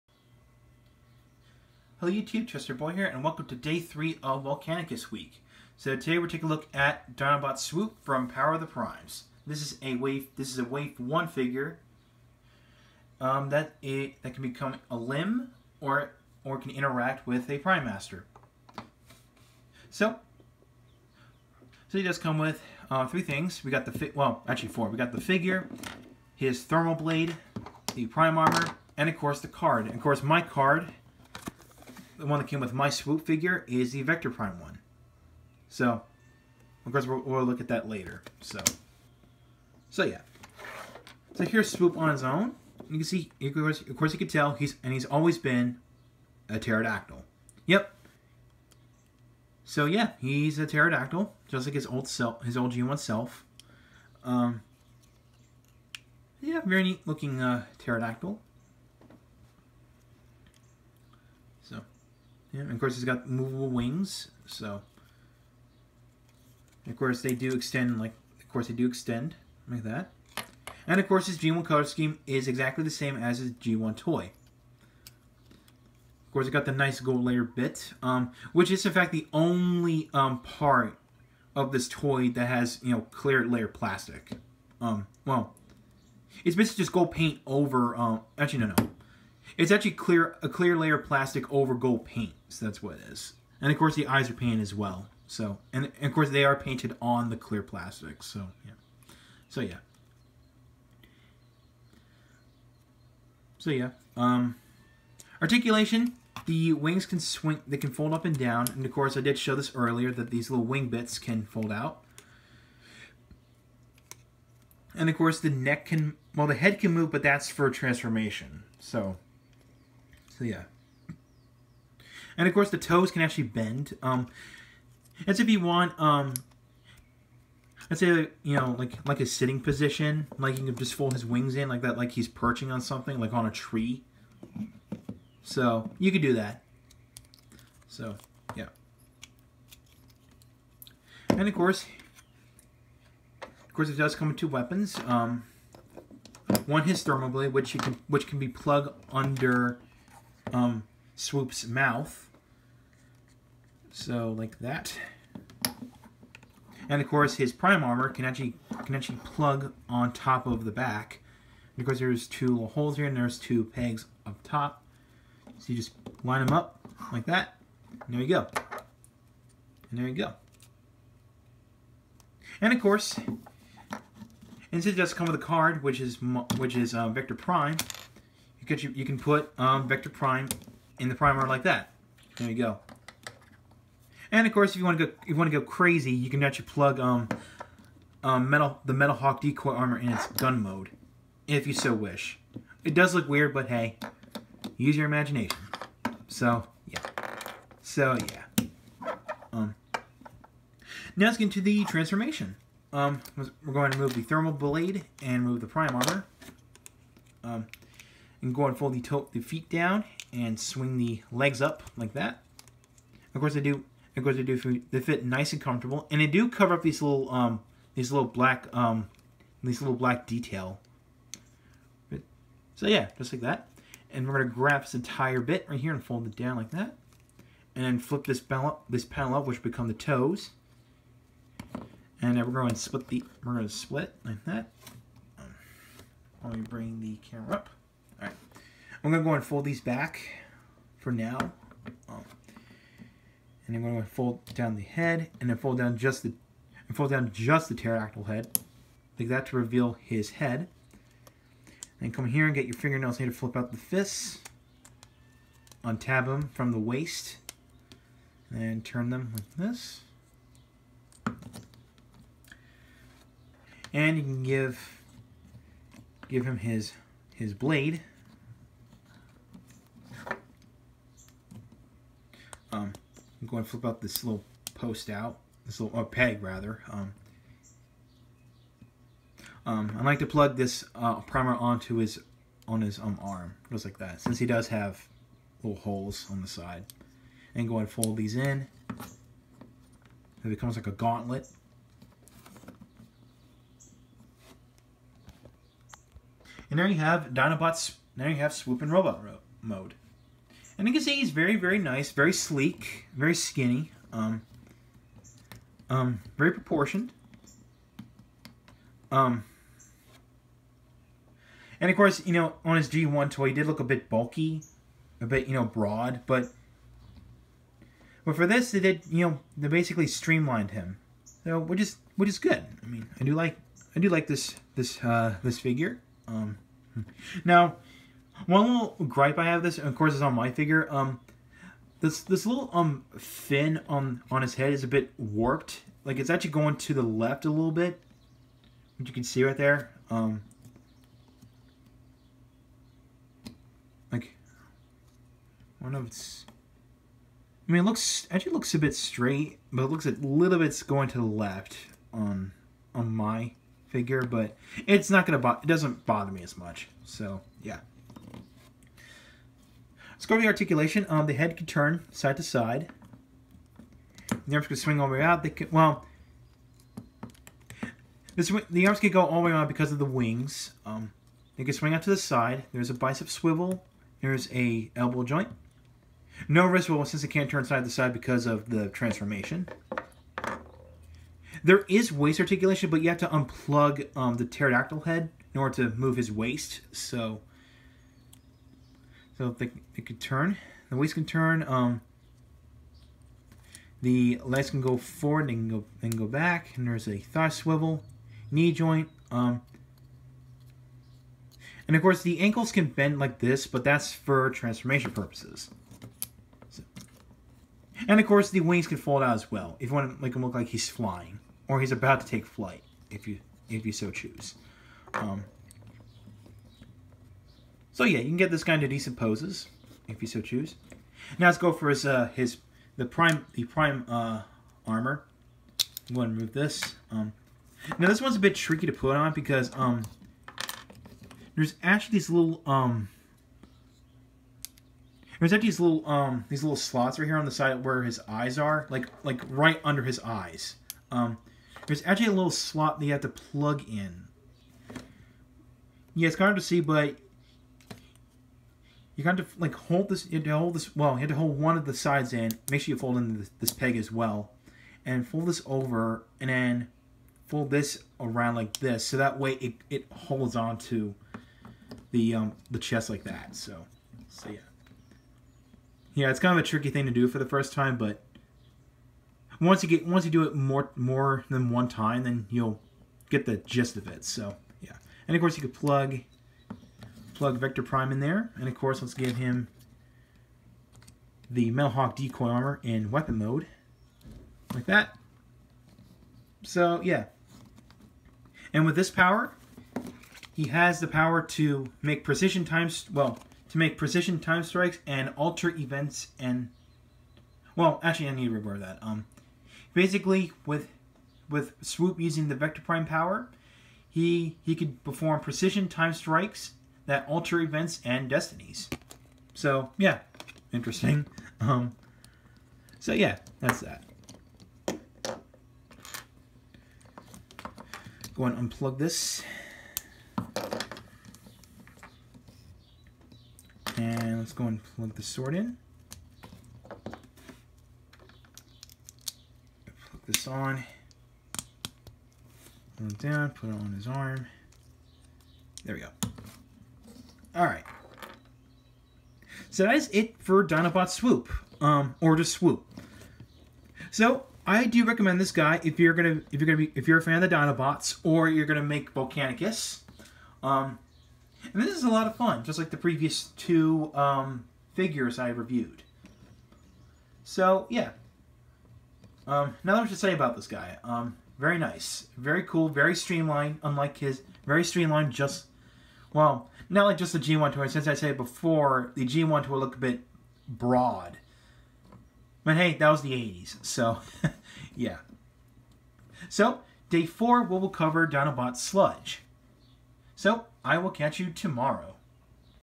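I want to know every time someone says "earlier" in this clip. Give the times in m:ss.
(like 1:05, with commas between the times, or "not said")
1:49.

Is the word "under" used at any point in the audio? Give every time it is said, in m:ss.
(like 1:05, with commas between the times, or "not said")
2:29, 7:19.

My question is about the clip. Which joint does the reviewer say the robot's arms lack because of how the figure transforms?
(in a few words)
wrist swivel.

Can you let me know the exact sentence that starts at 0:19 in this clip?
So, so he does come with uh, three things.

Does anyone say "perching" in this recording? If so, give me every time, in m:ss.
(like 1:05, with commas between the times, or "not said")
2:12.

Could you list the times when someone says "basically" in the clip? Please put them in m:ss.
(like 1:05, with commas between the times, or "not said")
1:26, 5:19, 8:19.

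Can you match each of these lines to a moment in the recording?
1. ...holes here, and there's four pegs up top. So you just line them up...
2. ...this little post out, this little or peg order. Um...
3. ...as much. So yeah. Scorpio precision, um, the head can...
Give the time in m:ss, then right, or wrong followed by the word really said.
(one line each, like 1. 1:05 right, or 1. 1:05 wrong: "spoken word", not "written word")
1. 2:42 wrong: "two", not "four"
2. 4:34 wrong: "rather", not "order"
3. 5:56 wrong: "articulation", not "precision".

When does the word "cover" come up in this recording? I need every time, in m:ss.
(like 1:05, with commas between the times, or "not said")
3:36, 9:37.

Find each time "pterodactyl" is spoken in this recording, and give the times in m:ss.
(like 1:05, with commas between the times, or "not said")
0:46, 0:50, 0:57, 4:07, 6:24.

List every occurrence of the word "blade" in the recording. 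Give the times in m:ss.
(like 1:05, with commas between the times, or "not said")
0:26, 2:27, 3:24, 4:27.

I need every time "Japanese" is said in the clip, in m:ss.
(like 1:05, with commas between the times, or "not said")
not said.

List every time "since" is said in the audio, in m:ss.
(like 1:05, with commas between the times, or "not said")
2:54, 4:44, 6:17, 9:27.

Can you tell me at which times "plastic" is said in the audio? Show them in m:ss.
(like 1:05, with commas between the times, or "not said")
1:23, 1:31, 1:37.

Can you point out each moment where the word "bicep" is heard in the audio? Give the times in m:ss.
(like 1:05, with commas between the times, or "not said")
6:12.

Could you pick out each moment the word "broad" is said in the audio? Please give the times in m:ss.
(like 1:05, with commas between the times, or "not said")
5:15, 9:30.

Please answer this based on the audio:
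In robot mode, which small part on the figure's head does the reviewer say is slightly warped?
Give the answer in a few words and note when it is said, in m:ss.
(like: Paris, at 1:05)
fin, at 5:33.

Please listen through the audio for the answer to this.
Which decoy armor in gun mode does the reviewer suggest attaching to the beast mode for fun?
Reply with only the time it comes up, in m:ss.
3:08.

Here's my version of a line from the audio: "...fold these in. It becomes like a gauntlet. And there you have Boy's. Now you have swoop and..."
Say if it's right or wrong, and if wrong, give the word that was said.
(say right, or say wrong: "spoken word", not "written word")
wrong: "Dinobot", not "Boy".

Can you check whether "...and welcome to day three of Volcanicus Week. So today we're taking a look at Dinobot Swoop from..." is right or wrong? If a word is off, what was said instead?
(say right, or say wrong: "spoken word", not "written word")
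right.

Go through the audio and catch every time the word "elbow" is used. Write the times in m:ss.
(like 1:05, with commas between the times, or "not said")
6:14.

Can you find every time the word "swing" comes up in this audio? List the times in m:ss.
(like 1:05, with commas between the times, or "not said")
1:47, 3:30, 6:04, 6:11.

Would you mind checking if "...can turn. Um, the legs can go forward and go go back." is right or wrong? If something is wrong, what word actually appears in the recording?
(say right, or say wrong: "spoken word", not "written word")
right.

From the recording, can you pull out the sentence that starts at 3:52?
And then we're going to split the we're going to split like that.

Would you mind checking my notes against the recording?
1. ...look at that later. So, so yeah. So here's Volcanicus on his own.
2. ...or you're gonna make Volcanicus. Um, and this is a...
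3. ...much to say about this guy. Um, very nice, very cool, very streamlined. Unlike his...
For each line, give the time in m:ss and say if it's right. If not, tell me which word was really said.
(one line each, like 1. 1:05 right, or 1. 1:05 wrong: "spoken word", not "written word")
1. 0:37 wrong: "Swoop", not "Volcanicus"
2. 9:08 right
3. 9:20 right.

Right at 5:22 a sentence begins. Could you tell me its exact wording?
I mean, I do like I do like this this uh, this figure.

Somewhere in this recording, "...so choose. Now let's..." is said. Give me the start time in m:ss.
7:00.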